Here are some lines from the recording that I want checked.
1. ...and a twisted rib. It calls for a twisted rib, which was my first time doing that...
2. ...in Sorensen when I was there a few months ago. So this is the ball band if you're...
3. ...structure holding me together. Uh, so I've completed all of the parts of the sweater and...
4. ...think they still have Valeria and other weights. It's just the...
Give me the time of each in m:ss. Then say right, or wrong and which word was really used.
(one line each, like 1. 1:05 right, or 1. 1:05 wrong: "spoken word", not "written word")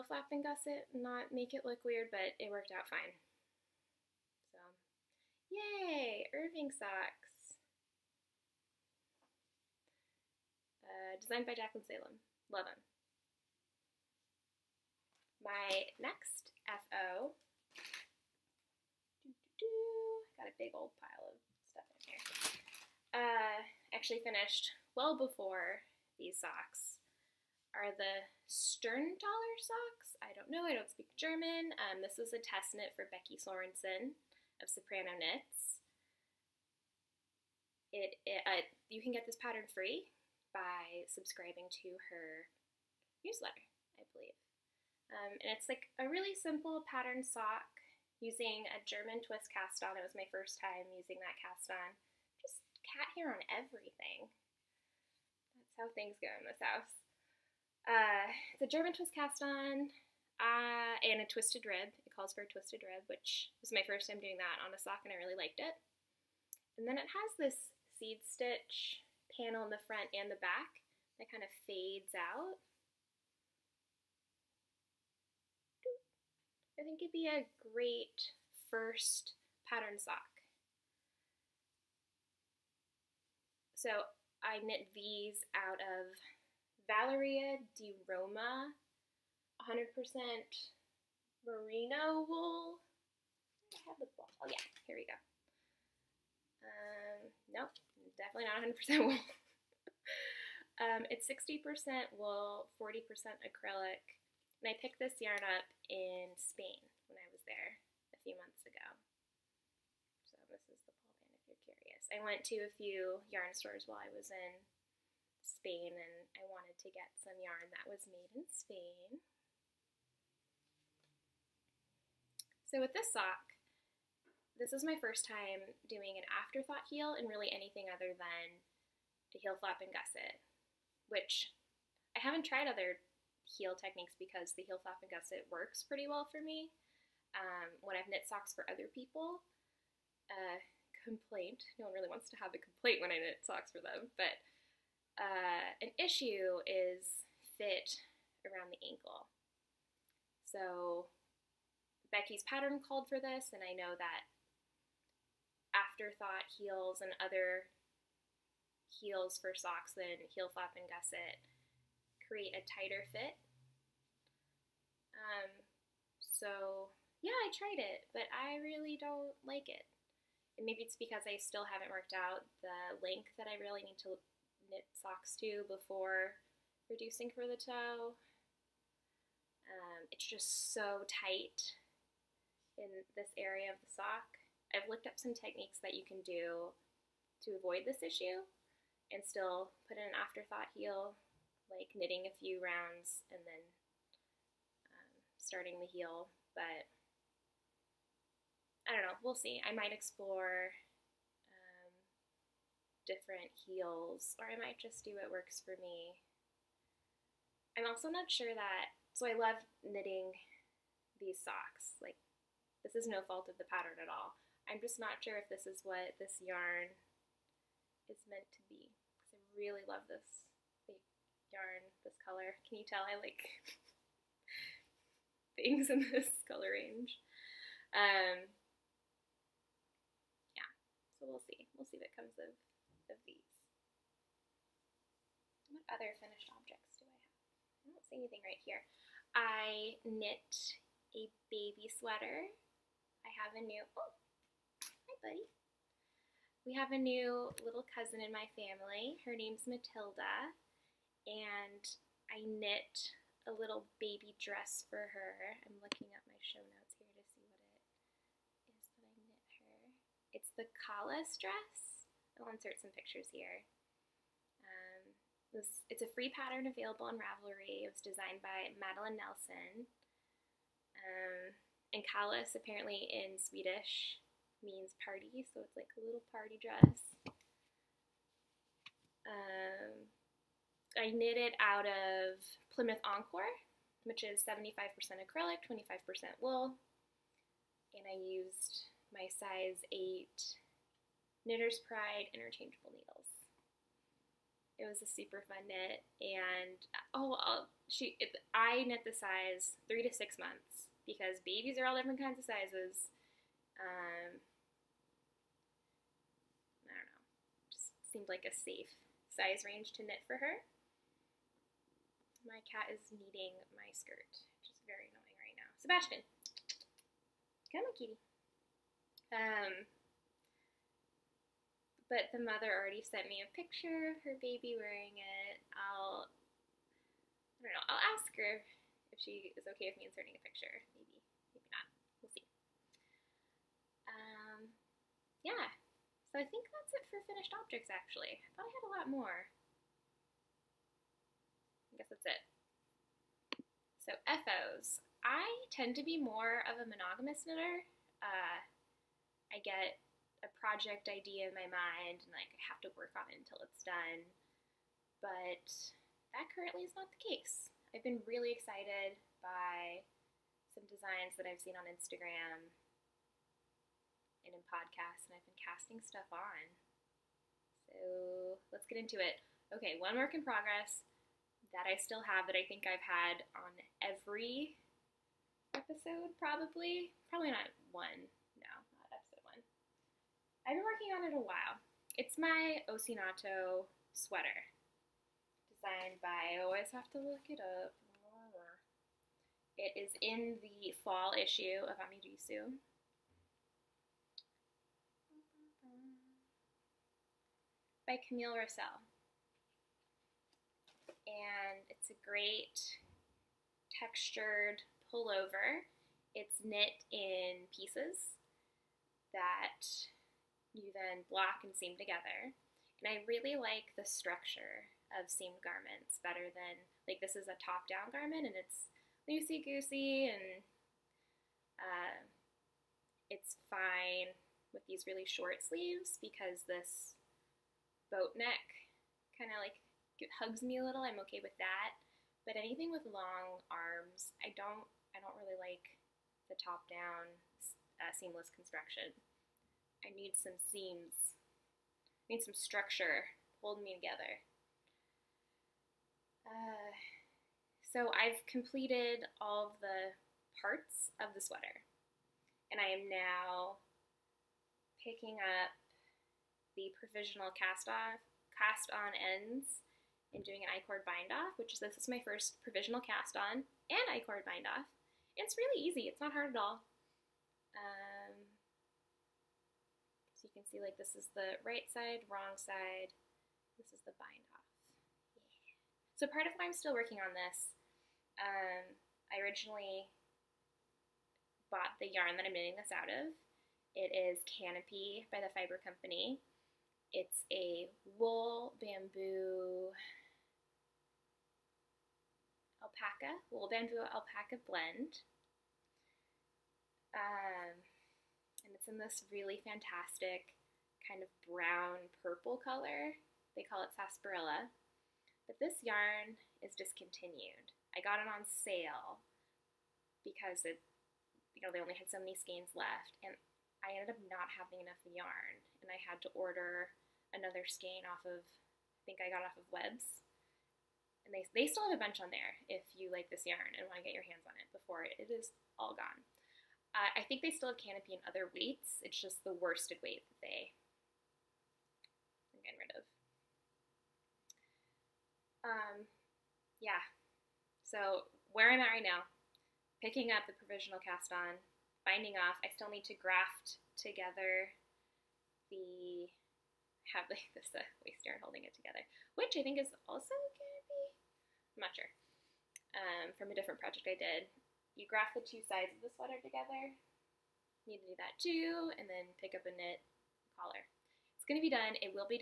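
1. 1:01 right
2. 1:45 wrong: "Spain", not "Sorensen"
3. 7:22 right
4. 8:47 wrong: "Canopy", not "Valeria".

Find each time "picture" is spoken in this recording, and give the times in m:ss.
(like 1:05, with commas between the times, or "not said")
4:22, 5:23, 5:30.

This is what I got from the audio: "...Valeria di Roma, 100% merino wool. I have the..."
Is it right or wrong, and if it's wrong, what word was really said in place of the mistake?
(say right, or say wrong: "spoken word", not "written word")
right.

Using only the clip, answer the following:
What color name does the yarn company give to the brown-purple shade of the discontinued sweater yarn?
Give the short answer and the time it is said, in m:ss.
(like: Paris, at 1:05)
sarsaparilla, at 8:23.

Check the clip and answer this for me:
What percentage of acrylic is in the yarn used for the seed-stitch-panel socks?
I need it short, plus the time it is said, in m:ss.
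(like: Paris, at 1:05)
40%, at 1:42.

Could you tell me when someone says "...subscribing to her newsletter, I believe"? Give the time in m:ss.
0:41.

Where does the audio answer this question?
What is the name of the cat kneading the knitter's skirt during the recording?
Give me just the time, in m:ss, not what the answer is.
5:15.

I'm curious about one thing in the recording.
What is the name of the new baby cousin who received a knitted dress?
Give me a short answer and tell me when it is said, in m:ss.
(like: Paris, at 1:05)
Matilda, at 4:09.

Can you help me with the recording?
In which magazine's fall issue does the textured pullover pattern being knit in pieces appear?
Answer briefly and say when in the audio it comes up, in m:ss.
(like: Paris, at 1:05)
Amirisu, at 6:31.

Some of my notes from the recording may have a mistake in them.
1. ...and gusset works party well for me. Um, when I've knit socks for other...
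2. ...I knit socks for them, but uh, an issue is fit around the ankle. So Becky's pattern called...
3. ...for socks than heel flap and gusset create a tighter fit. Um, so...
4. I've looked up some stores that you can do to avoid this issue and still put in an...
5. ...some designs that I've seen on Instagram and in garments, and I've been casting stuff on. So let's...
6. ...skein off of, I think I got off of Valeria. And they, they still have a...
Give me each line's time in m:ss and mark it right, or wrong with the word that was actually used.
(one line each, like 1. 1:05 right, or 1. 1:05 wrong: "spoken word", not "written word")
1. 2:15 wrong: "pretty", not "party"
2. 2:23 right
3. 2:39 right
4. 3:04 wrong: "techniques", not "stores"
5. 6:00 wrong: "podcasts", not "garments"
6. 8:37 wrong: "Webs", not "Valeria".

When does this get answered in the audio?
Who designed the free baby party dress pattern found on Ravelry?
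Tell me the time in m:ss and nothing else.
4:28.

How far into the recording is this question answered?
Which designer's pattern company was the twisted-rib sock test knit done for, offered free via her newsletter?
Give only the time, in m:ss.
0:34.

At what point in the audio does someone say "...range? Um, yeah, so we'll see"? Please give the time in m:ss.
3:46.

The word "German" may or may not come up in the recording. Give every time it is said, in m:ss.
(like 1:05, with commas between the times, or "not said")
0:31, 0:48, 0:58.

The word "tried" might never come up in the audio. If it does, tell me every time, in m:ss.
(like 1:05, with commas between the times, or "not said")
2:12, 2:47.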